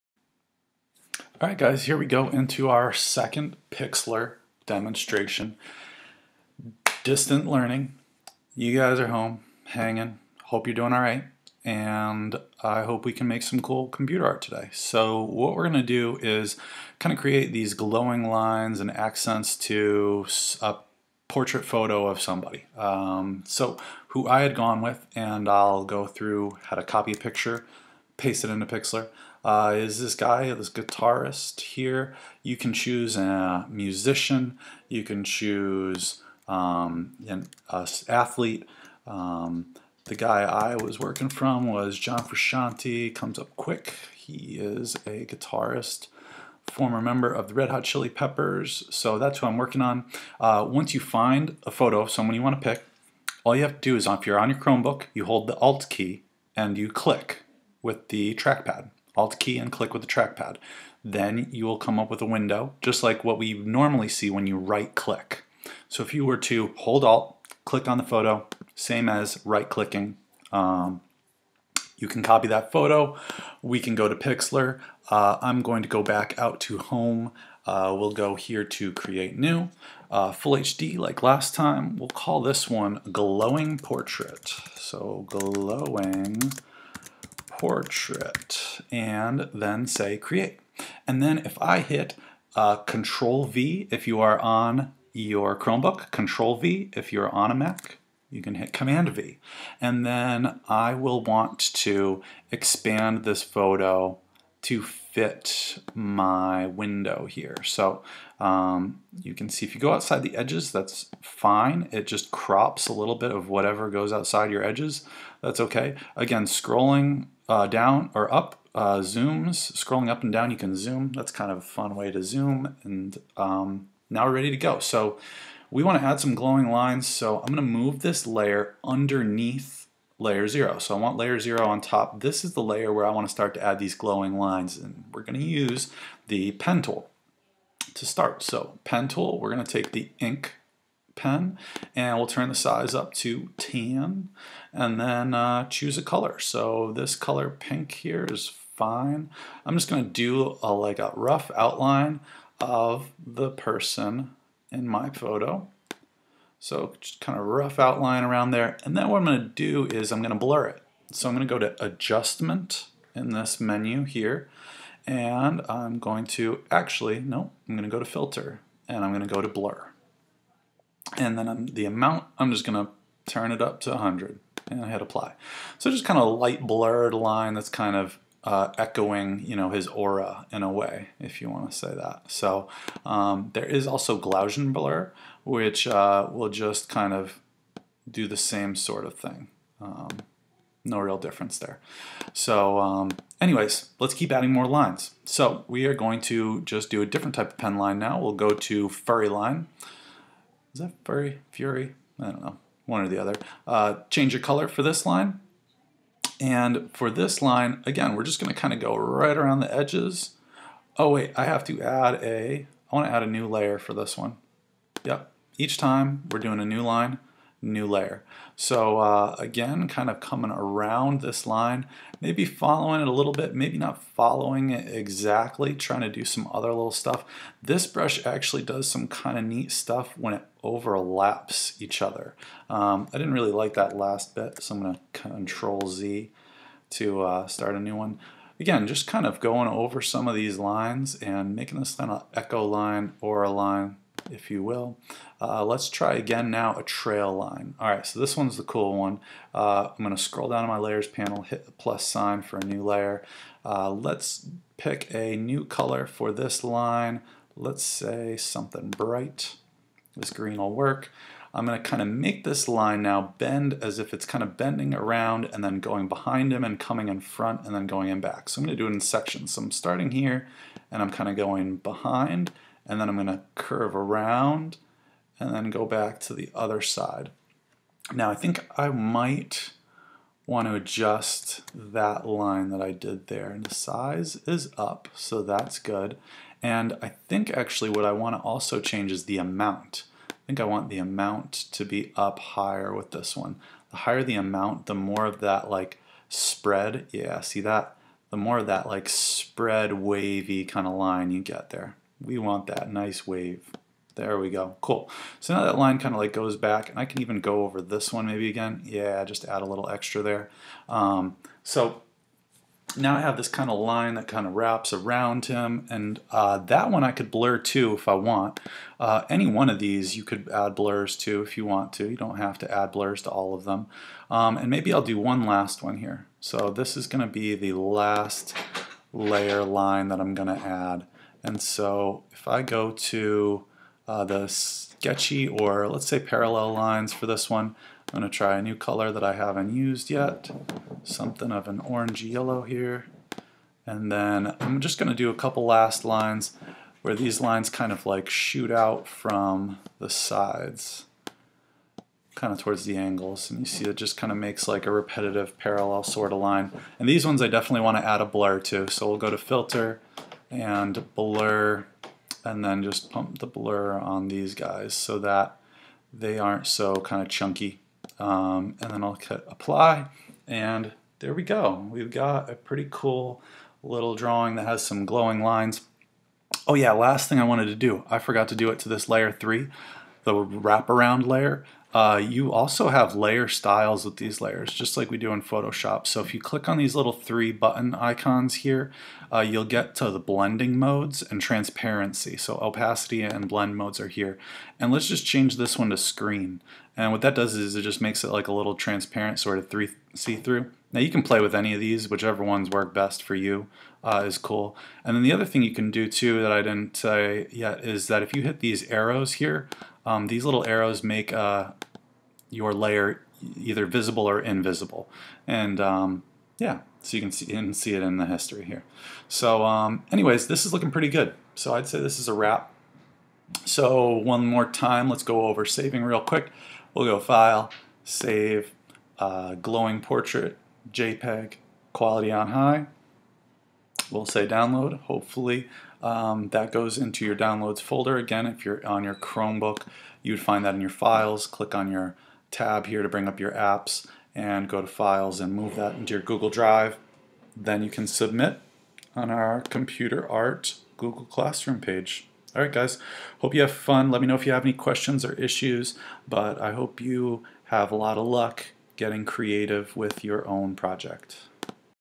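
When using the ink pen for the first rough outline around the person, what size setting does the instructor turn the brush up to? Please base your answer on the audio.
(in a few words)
10.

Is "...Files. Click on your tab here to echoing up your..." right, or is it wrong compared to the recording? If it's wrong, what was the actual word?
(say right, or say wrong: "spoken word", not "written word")
wrong: "bring", not "echoing".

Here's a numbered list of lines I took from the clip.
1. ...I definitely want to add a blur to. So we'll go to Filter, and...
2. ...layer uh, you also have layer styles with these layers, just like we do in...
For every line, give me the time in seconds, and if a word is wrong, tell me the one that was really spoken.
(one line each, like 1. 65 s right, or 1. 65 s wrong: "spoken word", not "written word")
1. 357 s right
2. 381 s right.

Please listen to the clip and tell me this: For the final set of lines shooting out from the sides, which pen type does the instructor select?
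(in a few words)
parallel lines.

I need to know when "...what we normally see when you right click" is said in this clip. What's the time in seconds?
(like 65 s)
63 s.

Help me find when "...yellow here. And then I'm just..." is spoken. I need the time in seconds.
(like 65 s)
342 s.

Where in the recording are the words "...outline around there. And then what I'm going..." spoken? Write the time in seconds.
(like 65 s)
157 s.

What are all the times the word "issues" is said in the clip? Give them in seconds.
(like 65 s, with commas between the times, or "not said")
455 s.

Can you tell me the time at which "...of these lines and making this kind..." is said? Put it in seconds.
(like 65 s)
240 s.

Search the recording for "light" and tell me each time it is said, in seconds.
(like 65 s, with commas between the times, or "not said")
176 s.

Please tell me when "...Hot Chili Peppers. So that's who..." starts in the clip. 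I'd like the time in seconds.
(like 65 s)
47 s.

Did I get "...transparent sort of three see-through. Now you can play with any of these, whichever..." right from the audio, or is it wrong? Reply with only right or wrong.
right.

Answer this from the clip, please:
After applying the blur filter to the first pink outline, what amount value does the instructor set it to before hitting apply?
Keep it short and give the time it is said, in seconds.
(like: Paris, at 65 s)
100, at 173 s.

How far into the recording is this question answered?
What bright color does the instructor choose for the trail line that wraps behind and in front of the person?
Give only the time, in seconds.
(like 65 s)
260 s.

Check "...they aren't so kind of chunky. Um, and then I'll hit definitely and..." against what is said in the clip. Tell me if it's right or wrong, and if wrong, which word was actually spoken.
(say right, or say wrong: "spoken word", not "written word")
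wrong: "apply", not "definitely".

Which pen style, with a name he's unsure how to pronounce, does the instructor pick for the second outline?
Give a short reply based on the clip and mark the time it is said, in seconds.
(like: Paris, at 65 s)
furry line, at 198 s.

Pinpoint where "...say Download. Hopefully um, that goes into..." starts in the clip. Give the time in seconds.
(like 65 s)
434 s.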